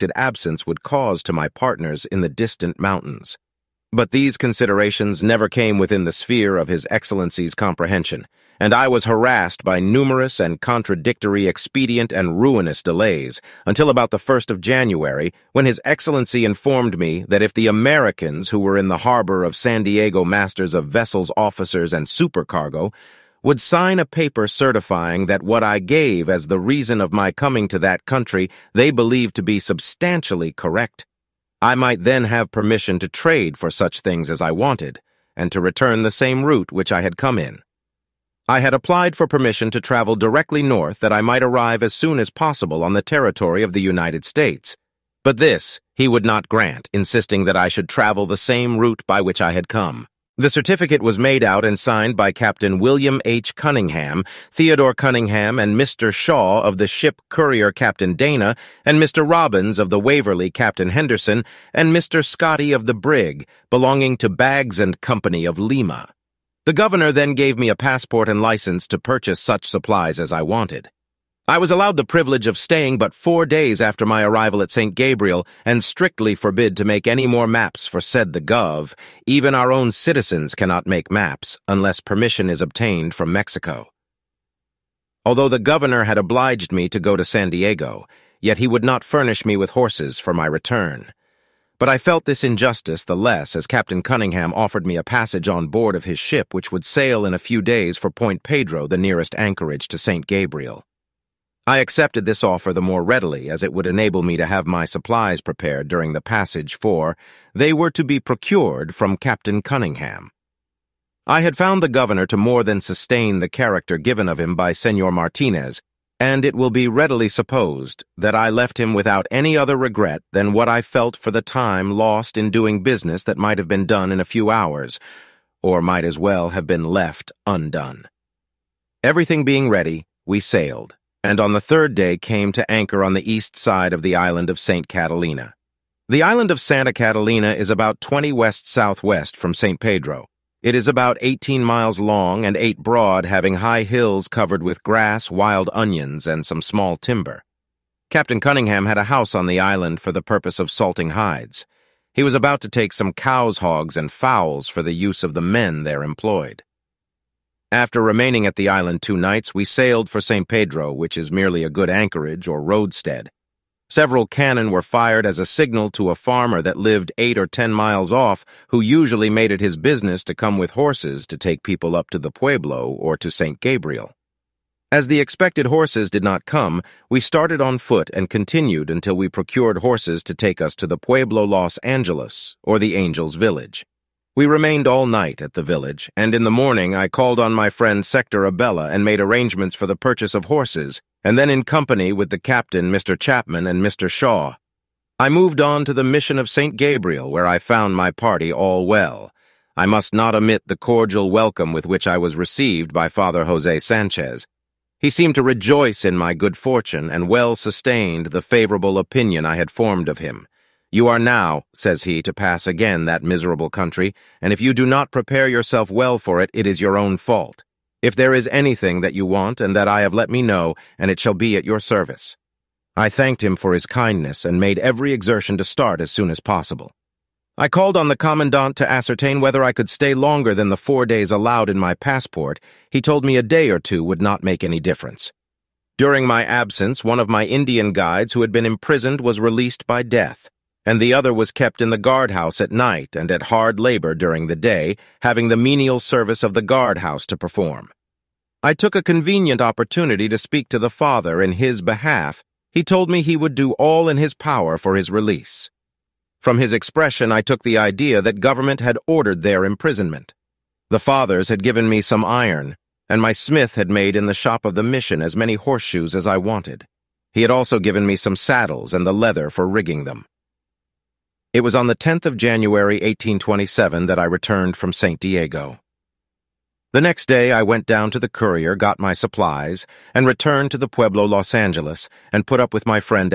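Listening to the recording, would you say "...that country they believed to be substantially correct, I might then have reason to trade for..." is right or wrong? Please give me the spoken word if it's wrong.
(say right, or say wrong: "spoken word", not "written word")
wrong: "permission", not "reason".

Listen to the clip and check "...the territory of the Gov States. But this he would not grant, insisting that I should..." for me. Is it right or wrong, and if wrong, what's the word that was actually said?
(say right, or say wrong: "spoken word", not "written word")
wrong: "United", not "Gov".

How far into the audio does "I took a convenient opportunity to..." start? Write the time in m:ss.
4:08.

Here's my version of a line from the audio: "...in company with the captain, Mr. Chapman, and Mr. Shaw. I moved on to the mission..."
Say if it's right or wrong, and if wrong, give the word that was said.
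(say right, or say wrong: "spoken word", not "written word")
right.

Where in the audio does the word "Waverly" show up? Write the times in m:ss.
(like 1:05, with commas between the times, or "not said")
0:59.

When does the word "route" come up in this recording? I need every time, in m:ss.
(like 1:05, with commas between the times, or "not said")
0:36, 0:48.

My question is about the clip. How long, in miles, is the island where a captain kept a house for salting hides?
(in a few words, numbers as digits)
18.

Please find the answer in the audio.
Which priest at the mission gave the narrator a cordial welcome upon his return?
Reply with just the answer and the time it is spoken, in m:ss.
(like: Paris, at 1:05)
Father Jose Sanchez, at 3:23.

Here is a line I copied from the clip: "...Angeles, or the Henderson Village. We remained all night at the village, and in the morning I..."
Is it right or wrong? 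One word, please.
wrong.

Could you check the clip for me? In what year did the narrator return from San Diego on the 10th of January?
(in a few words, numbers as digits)
1827.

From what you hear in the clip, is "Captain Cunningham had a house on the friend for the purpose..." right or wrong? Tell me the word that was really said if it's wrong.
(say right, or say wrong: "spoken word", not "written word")
wrong: "island", not "friend".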